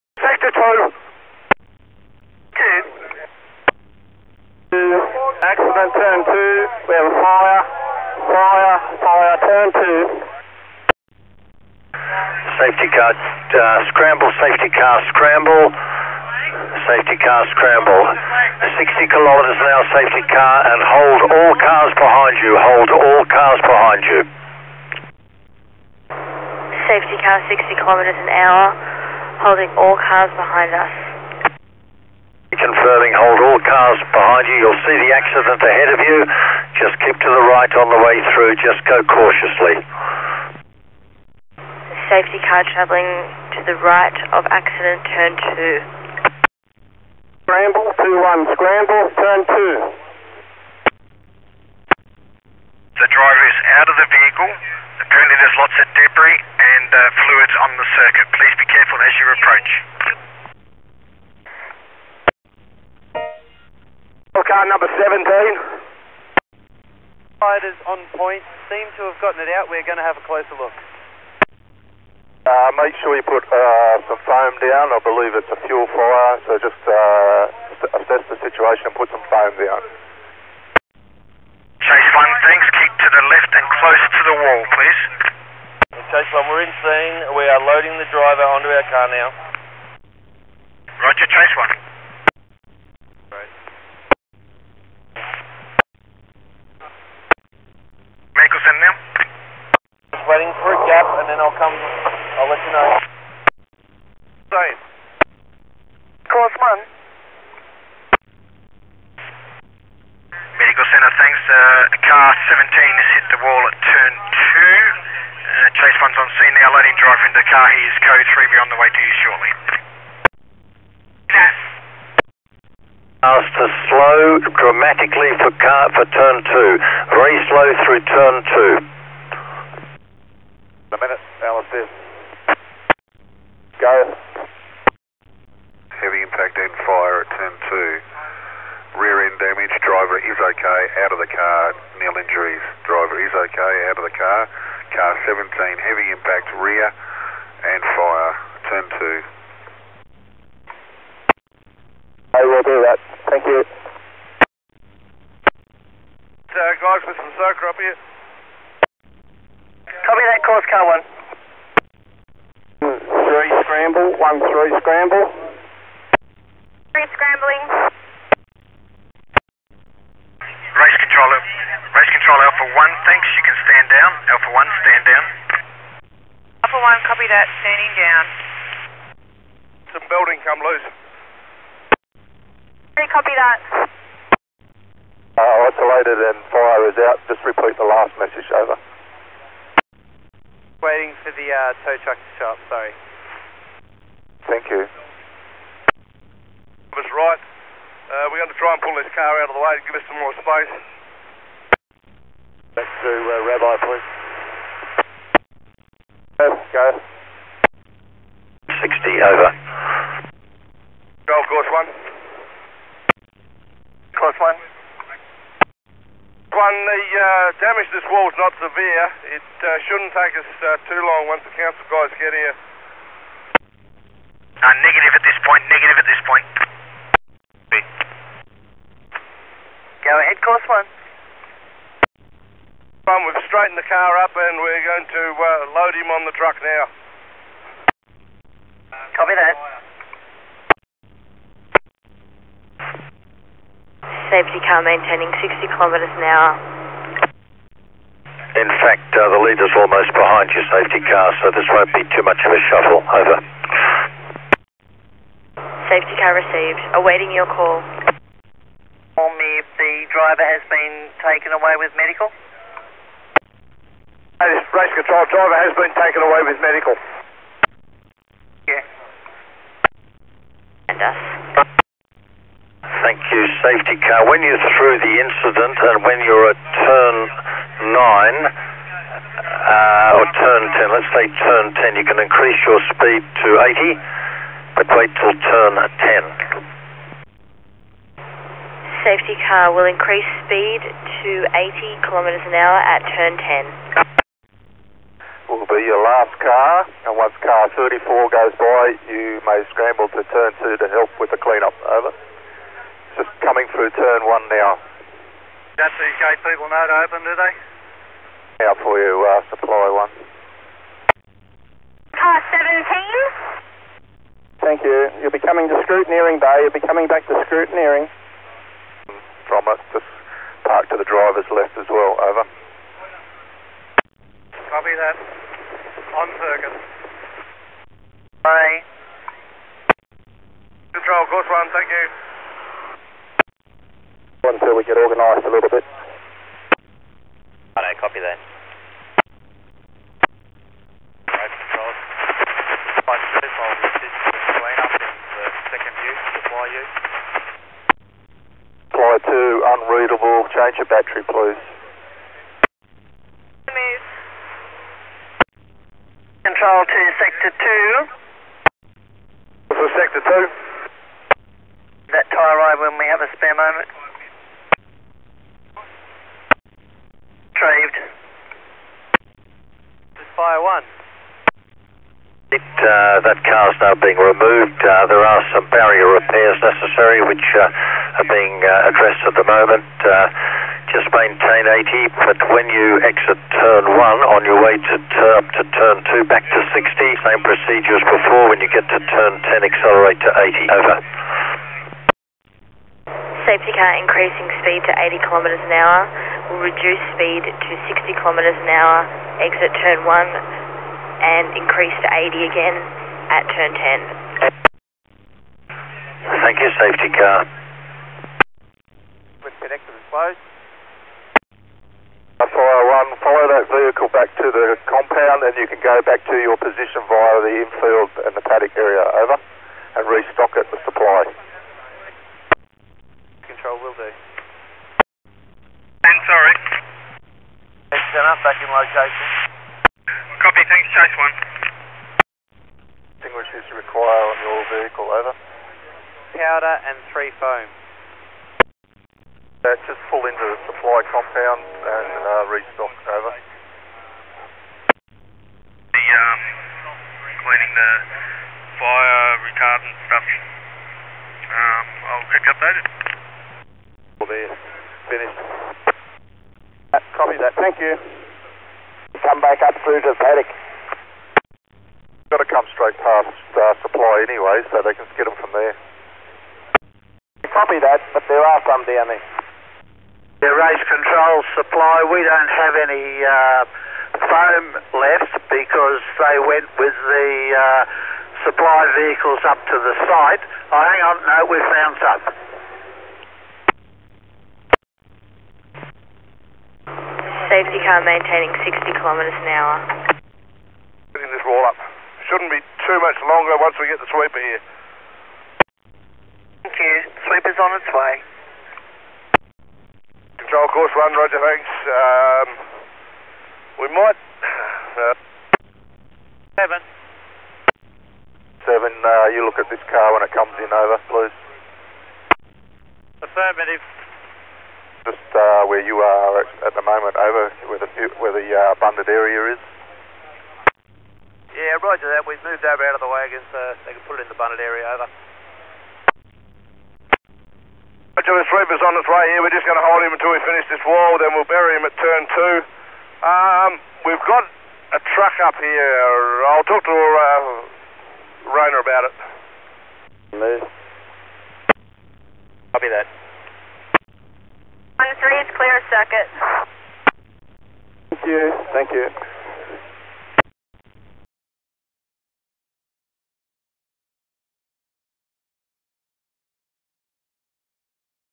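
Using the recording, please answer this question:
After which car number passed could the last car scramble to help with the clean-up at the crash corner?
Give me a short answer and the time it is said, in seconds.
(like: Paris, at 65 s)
34, at 297 s.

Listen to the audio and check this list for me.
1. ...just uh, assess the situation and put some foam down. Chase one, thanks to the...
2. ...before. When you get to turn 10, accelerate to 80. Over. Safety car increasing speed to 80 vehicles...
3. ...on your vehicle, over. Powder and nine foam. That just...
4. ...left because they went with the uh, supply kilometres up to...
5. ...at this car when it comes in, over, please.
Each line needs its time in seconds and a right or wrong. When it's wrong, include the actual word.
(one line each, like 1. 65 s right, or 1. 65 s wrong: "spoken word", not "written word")
1. 76 s right
2. 388 s wrong: "kilometres", not "vehicles"
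3. 434 s wrong: "three", not "nine"
4. 474 s wrong: "vehicles", not "kilometres"
5. 509 s right.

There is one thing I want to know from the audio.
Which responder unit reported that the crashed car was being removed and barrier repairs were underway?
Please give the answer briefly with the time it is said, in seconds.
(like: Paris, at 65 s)
Fire 1, at 370 s.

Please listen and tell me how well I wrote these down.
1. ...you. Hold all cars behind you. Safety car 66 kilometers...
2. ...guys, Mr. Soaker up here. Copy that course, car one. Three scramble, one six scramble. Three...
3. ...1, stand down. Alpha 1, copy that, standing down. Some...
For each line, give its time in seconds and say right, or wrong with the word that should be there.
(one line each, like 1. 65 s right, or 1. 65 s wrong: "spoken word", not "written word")
1. 22 s wrong: "60", not "66"
2. 156 s wrong: "three", not "six"
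3. 174 s right.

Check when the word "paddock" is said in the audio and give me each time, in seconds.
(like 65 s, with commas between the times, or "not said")
418 s, 460 s.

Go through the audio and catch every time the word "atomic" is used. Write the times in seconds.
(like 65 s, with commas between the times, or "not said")
not said.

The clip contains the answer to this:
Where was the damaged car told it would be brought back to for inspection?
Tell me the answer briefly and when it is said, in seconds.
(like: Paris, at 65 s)
Scrutineering bay, at 315 s.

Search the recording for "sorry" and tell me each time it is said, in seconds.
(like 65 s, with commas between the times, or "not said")
192 s, 426 s.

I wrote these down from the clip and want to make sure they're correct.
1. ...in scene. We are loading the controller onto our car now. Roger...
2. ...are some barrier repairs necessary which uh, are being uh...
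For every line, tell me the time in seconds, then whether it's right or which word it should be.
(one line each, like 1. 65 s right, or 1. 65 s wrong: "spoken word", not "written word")
1. 86 s wrong: "driver", not "controller"
2. 375 s right.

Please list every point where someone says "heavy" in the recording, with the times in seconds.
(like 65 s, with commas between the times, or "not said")
135 s, 145 s.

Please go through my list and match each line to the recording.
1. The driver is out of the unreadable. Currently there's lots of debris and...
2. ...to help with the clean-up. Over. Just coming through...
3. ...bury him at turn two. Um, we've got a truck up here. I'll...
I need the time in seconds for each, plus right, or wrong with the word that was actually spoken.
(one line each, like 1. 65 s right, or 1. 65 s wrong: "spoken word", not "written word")
1. 52 s wrong: "vehicle", not "unreadable"
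2. 300 s right
3. 531 s right.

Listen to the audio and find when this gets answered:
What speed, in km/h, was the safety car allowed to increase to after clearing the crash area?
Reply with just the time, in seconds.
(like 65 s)
282 s.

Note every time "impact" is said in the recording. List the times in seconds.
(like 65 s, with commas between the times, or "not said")
136 s, 146 s.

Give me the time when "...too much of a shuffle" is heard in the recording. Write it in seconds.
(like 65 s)
252 s.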